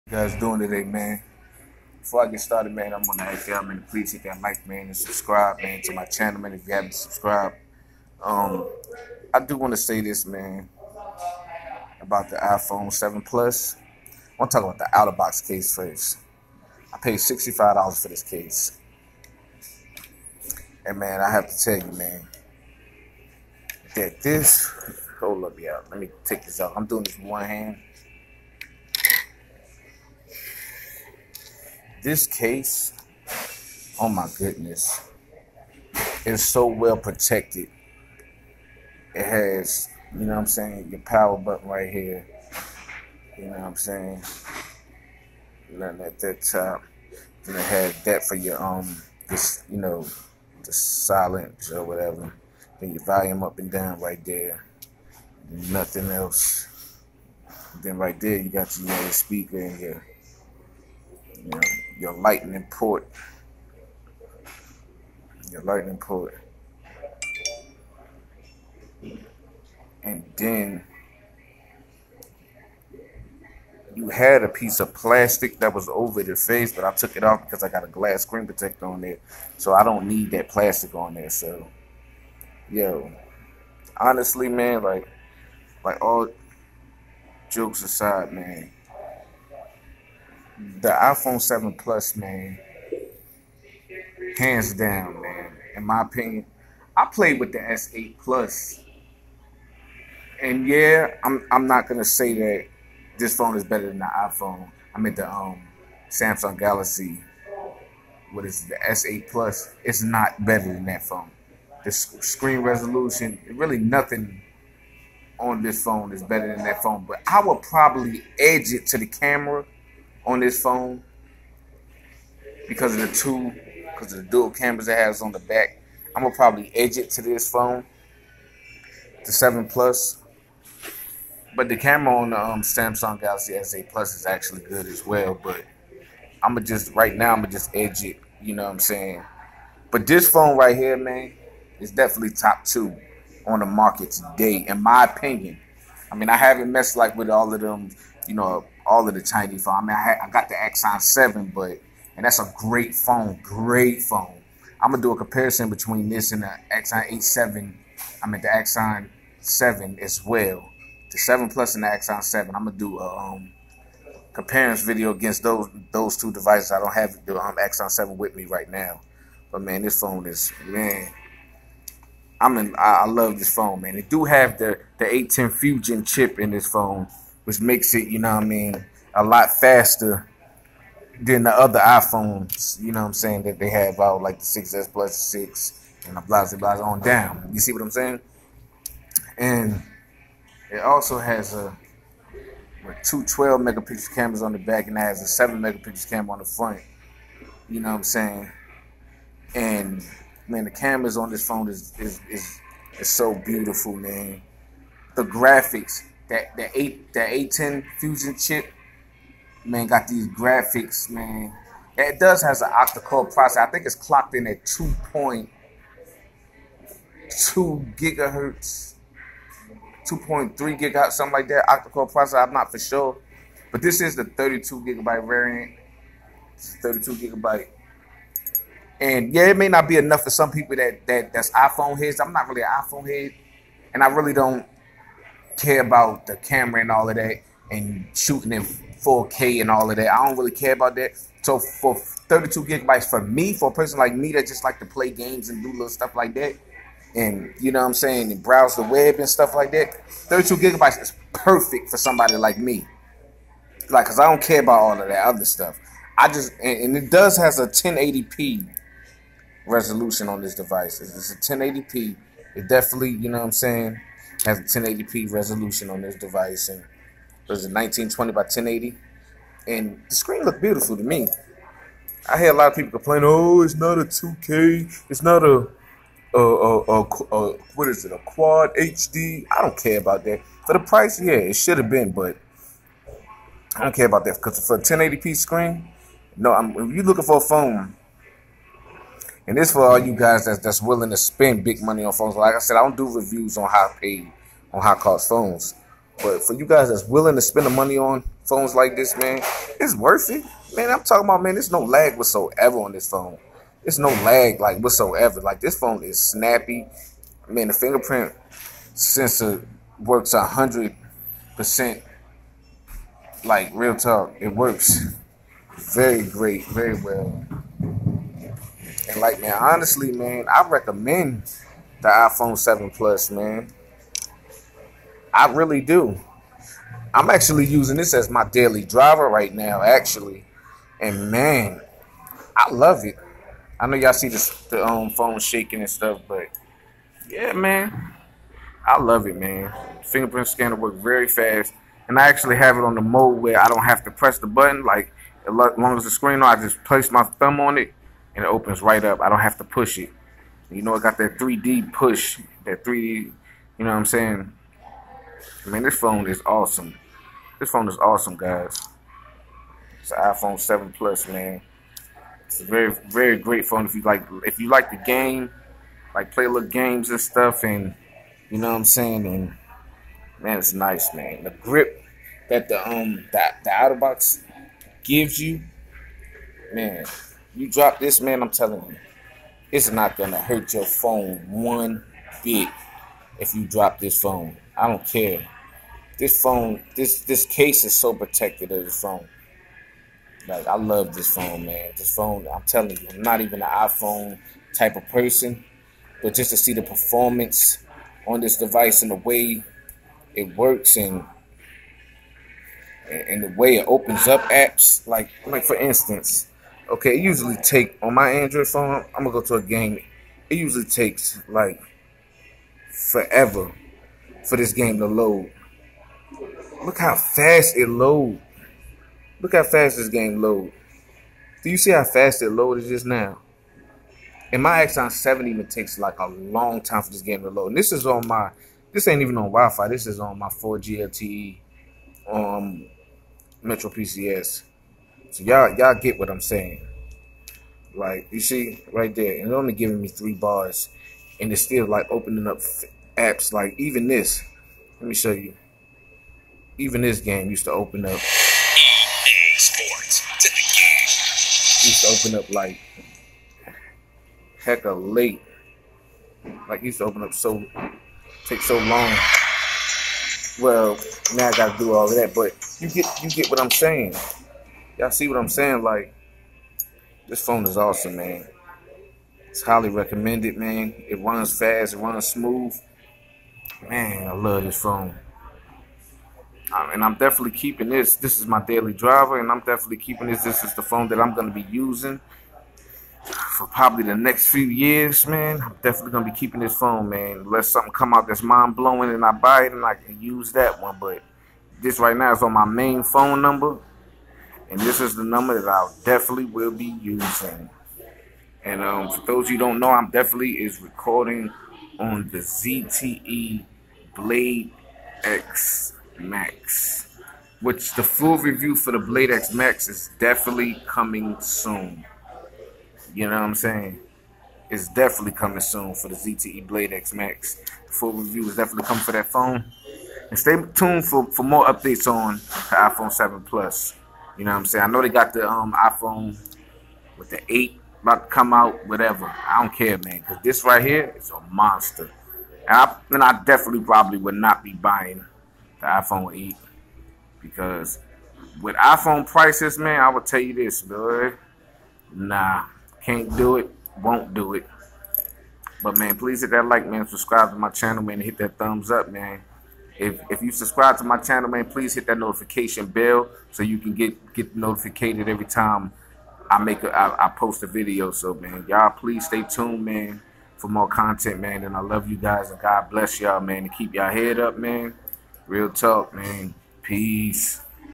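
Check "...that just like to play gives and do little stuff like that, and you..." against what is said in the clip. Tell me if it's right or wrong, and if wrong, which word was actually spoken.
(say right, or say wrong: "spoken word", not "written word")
wrong: "games", not "gives".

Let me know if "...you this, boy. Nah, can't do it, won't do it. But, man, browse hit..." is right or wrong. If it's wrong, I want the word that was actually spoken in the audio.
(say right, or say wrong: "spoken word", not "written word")
wrong: "please", not "browse".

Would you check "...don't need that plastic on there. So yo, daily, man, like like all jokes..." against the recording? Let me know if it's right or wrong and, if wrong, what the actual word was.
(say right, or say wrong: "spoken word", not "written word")
wrong: "honestly", not "daily".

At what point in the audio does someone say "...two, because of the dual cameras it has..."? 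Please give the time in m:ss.
2:03.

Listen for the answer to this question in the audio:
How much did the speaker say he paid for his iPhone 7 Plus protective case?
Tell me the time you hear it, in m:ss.
0:17.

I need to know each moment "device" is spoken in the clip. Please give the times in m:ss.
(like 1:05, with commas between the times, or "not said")
2:46, 4:20, 4:26, 6:38.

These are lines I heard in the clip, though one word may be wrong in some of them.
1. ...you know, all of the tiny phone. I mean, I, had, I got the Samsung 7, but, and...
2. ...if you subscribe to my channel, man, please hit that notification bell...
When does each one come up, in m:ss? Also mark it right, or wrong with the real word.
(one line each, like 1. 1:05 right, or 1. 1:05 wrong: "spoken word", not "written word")
1. 2:28 wrong: "Axon", not "Samsung"
2. 9:10 right.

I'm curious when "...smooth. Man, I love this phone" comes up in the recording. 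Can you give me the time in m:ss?
7:52.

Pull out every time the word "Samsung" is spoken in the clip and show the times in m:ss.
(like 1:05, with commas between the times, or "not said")
1:46, 2:12.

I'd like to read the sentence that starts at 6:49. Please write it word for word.
I'm gonna go to a game.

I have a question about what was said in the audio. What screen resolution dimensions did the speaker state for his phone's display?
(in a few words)
1920 by 1080.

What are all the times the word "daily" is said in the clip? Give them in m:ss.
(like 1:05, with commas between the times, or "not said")
5:28, 7:58.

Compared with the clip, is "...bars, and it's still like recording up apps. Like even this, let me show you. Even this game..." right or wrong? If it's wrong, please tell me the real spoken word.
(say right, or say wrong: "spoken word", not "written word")
wrong: "opening", not "recording".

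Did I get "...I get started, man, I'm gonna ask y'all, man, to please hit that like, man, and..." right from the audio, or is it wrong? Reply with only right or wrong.
right.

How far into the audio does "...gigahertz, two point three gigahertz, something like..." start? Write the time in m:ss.
3:37.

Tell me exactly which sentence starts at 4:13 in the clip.
Like, cause I don't care about all of that other stuff.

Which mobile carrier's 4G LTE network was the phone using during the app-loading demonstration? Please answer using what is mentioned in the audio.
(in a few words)
Metro PCS.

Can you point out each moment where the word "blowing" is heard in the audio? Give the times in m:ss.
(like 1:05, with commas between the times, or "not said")
8:08.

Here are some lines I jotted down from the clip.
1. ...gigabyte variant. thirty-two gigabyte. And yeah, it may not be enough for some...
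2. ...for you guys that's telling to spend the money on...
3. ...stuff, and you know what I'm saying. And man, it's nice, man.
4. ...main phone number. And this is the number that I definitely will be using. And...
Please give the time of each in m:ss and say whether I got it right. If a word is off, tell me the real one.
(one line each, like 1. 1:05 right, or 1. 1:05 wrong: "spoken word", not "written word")
1. 3:44 right
2. 4:56 wrong: "willing", not "telling"
3. 6:07 right
4. 8:12 right.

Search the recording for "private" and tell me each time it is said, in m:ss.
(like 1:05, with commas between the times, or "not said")
not said.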